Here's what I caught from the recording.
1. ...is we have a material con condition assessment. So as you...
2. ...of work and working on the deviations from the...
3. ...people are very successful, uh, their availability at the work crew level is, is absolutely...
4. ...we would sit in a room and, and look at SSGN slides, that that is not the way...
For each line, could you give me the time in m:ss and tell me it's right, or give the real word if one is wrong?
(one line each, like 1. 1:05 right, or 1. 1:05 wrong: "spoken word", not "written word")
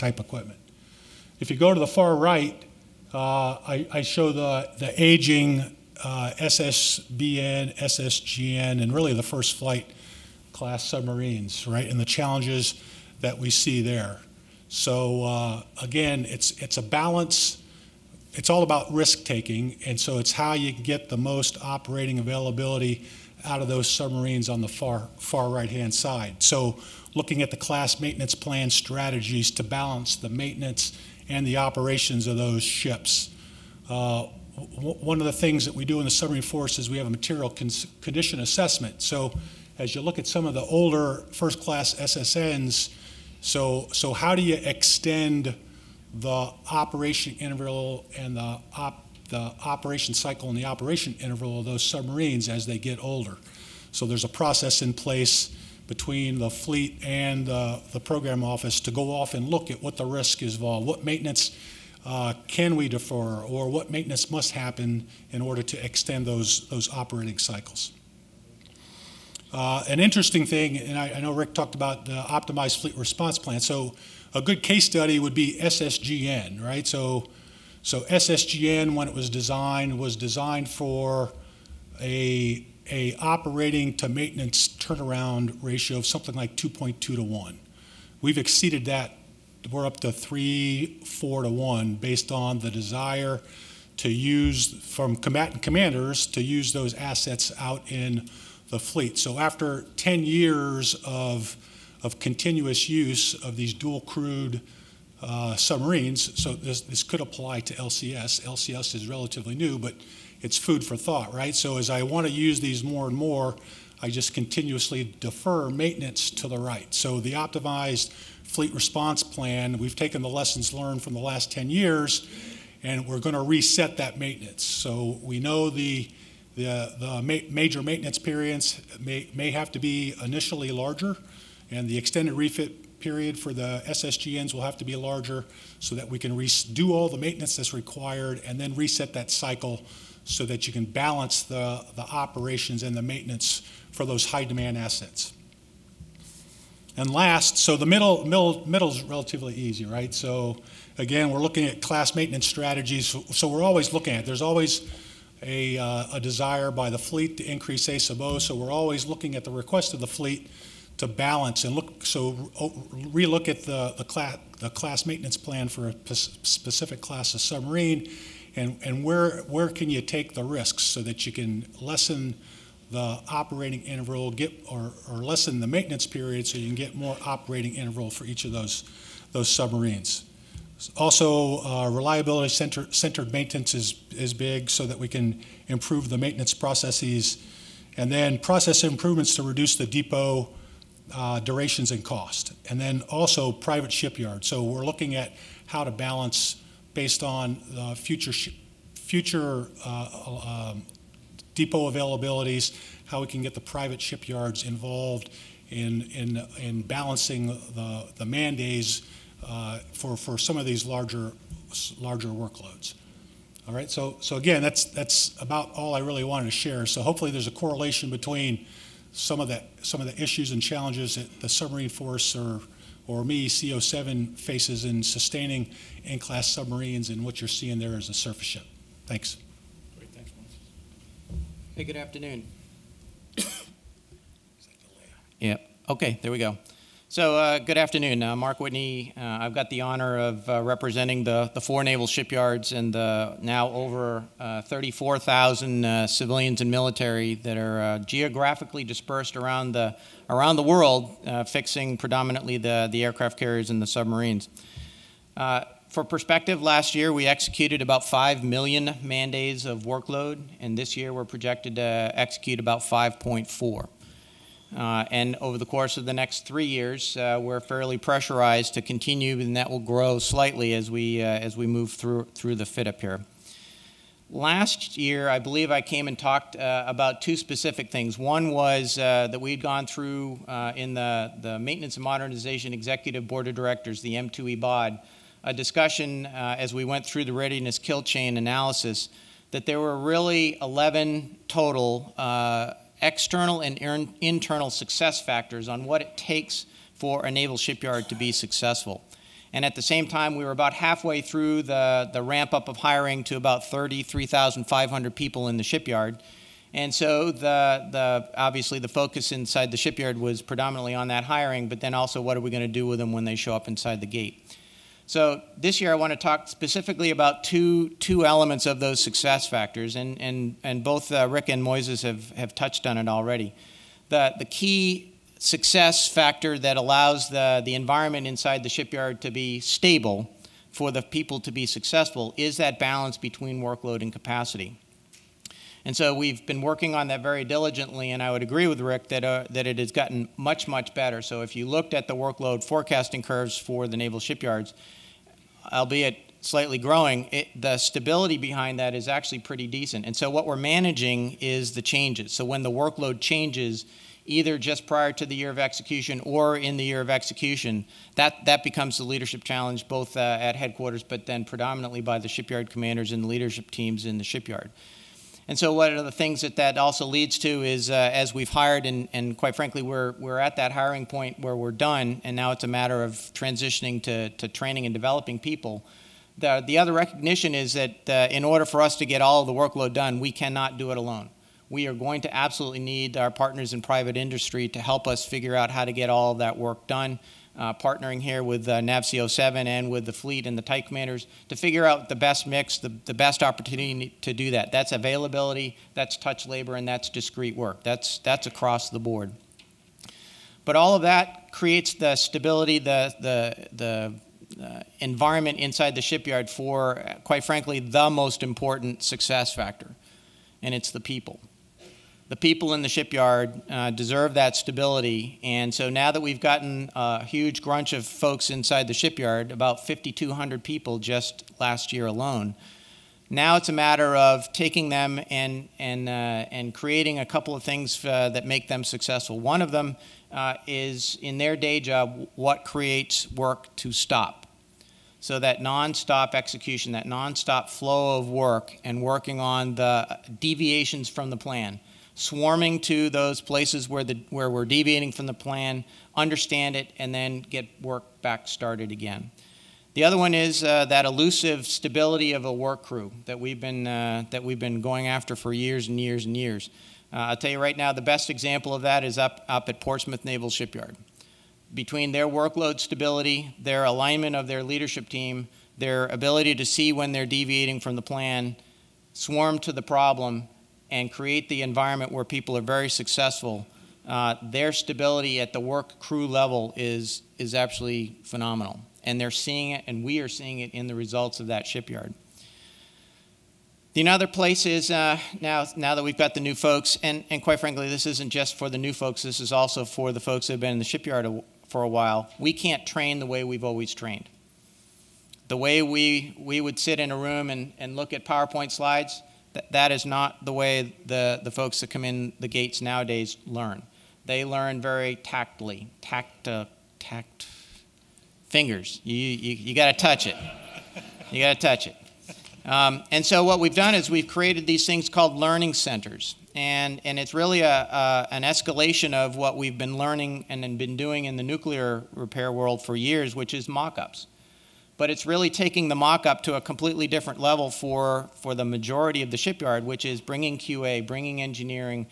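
1. 0:36 right
2. 7:18 right
3. 7:52 wrong: "stability", not "availability"
4. 8:16 wrong: "PowerPoint", not "SSGN".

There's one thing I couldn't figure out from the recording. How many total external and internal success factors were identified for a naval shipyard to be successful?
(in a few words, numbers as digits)
11.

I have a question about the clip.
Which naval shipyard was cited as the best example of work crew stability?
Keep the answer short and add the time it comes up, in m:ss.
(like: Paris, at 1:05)
Portsmouth Naval Shipyard, at 7:39.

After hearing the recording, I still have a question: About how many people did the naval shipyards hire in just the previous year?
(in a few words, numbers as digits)
5,200.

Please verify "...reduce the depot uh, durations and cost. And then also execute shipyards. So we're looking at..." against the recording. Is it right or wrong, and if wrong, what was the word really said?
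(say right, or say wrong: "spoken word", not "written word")
wrong: "private", not "execute".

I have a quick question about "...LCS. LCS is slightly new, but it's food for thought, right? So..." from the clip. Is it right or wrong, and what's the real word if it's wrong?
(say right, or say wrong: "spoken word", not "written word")
wrong: "relatively", not "slightly".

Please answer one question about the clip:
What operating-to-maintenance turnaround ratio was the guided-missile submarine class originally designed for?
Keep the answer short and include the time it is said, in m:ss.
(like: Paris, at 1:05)
2.2 to 1, at 1:26.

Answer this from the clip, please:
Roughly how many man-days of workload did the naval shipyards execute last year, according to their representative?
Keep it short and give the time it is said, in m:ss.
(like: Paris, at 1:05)
5 million, at 4:18.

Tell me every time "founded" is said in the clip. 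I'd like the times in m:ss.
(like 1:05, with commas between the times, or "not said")
not said.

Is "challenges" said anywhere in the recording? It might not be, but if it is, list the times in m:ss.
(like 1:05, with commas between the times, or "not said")
0:12, 3:40, 5:59.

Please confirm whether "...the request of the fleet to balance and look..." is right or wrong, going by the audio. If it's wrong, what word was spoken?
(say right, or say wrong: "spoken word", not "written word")
right.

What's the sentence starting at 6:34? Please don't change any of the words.
That's availability, that's touch labor, and that's discrete work.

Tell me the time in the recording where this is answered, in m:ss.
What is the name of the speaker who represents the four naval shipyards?
3:58.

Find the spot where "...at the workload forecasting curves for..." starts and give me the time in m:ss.
5:41.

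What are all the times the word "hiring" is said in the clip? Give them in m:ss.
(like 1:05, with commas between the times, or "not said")
5:02, 5:11, 6:10.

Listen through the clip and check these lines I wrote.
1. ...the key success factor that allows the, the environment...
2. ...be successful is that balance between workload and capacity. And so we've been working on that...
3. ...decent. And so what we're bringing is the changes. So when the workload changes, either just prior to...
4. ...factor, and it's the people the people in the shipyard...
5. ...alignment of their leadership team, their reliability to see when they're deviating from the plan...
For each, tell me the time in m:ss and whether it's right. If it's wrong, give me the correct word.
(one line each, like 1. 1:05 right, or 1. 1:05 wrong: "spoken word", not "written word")
1. 5:24 right
2. 5:31 right
3. 5:49 wrong: "managing", not "bringing"
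4. 6:49 right
5. 7:43 wrong: "ability", not "reliability".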